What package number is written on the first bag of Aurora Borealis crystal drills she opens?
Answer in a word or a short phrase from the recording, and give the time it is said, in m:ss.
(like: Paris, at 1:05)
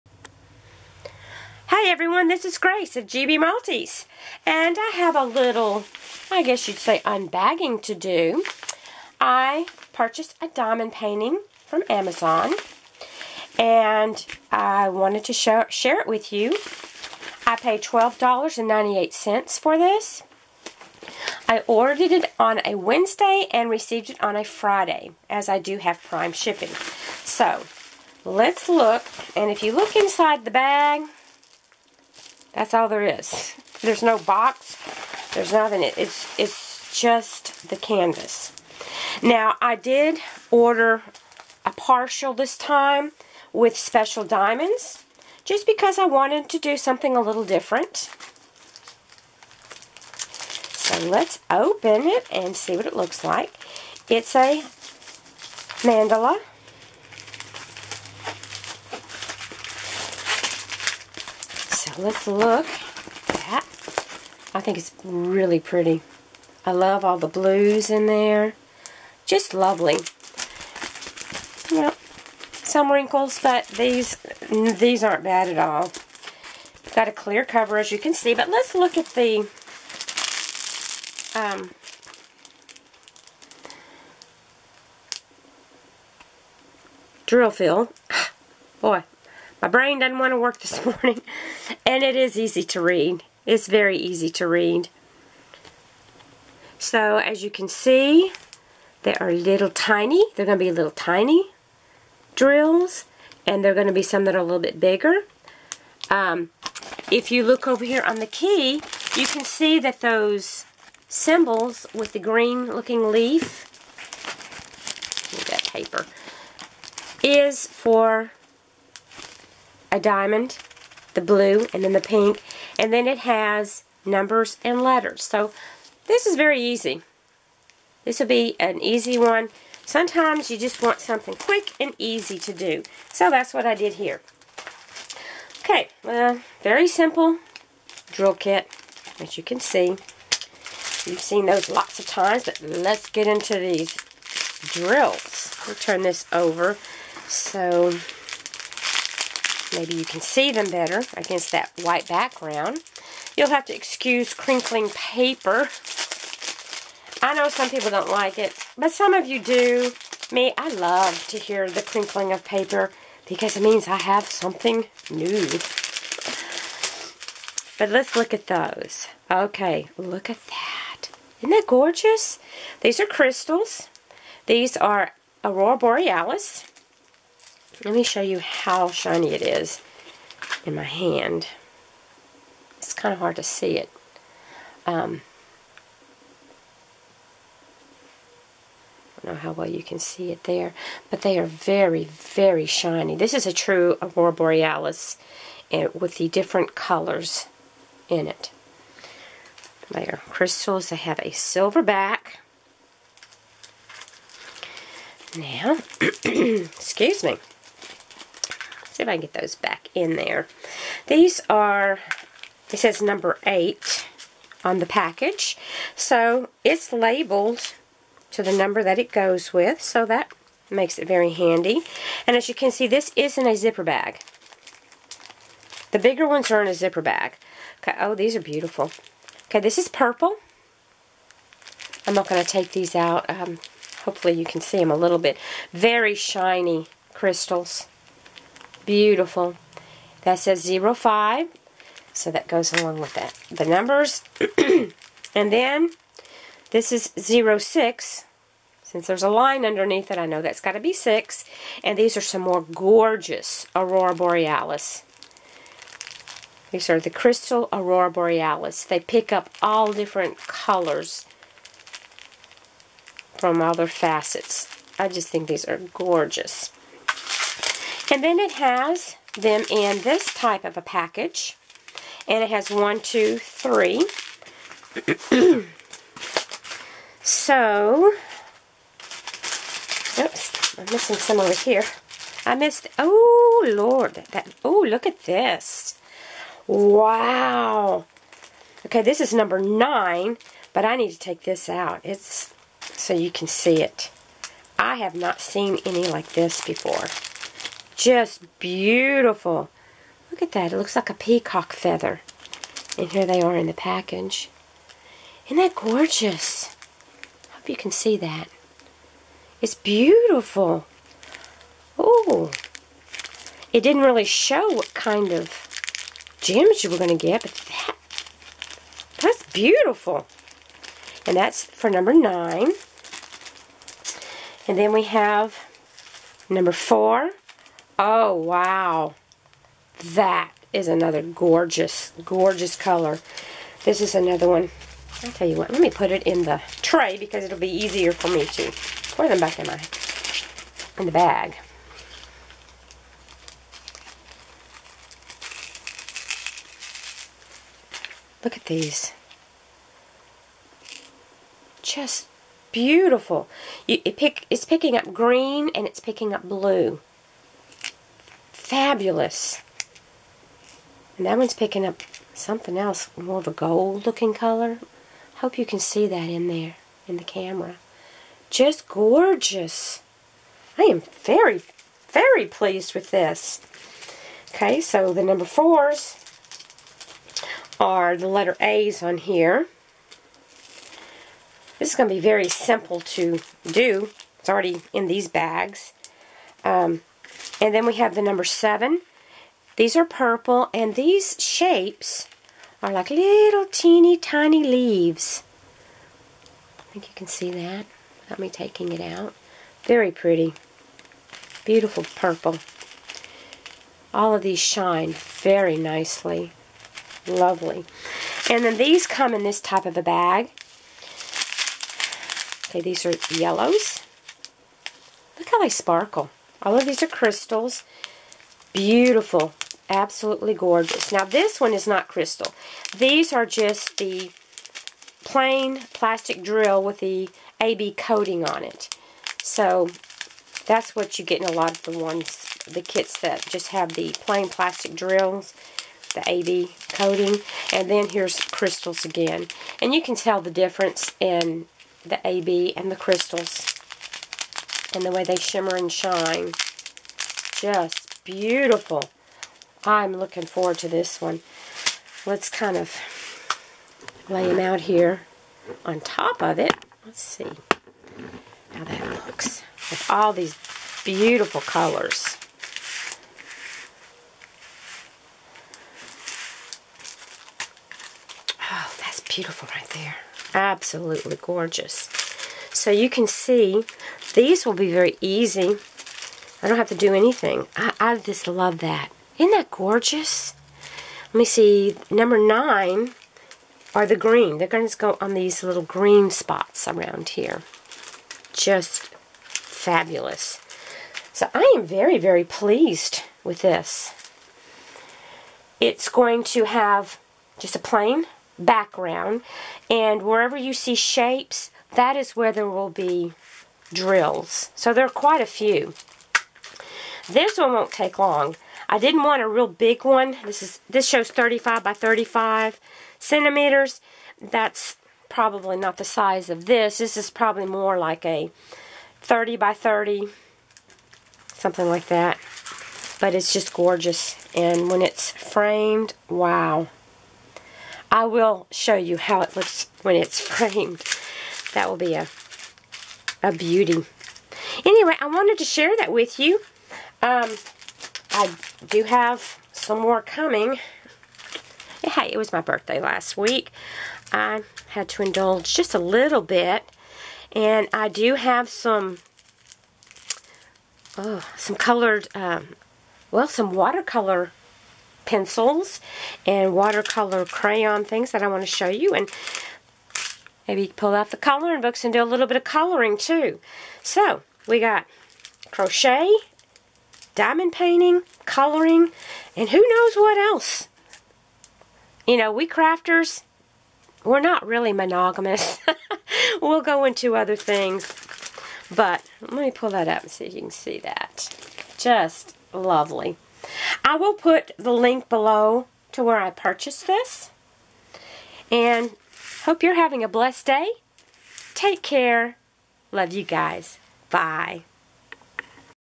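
8, at 3:33.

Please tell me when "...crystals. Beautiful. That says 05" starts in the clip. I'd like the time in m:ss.
3:57.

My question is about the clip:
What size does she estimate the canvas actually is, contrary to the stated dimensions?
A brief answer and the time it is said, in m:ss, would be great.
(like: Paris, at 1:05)
30 by 30, at 8:39.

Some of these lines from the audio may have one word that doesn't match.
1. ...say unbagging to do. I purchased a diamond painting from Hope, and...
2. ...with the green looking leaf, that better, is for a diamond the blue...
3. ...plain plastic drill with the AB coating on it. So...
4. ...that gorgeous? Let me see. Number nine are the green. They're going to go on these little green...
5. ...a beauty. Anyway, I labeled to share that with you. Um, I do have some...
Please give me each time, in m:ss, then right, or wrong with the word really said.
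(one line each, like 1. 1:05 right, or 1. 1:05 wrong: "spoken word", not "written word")
1. 0:06 wrong: "Amazon", not "Hope"
2. 1:51 wrong: "paper", not "better"
3. 7:05 right
4. 7:59 right
5. 8:53 wrong: "wanted", not "labeled".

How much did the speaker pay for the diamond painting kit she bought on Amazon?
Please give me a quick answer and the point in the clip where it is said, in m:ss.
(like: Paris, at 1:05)
$12.98, at 0:17.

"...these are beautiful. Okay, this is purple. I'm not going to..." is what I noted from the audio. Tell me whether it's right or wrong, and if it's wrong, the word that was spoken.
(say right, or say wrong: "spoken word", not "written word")
right.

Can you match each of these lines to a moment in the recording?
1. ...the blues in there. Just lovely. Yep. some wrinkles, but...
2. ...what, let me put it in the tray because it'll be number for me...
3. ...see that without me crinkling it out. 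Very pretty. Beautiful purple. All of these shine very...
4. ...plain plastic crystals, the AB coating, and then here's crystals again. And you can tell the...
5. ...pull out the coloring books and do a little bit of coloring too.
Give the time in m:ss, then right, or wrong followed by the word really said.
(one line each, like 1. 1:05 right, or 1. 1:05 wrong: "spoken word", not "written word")
1. 1:07 right
2. 5:35 wrong: "easier", not "number"
3. 6:37 wrong: "taking", not "crinkling"
4. 7:14 wrong: "drills", not "crystals"
5. 9:20 right.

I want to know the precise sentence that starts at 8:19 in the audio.
And wherever you see shapes, that is where there will be drills.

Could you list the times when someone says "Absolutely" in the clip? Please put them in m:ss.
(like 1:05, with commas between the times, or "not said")
6:59, 7:50.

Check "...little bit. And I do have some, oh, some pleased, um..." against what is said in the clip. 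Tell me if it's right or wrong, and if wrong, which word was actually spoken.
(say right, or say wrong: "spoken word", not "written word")
wrong: "colored", not "pleased".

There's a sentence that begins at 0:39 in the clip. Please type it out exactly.
Now, I did order a partial this time with special diamonds just because I wanted to do something a little different.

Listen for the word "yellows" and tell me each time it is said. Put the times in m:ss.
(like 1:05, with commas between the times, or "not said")
6:53.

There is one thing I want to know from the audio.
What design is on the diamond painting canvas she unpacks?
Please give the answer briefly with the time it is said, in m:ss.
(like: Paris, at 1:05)
Mandala, at 0:55.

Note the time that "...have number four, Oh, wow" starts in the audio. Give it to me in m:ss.
5:25.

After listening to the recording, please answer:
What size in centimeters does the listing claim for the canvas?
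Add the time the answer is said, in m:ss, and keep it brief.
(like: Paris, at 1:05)
35 by 35 centimeters, at 8:31.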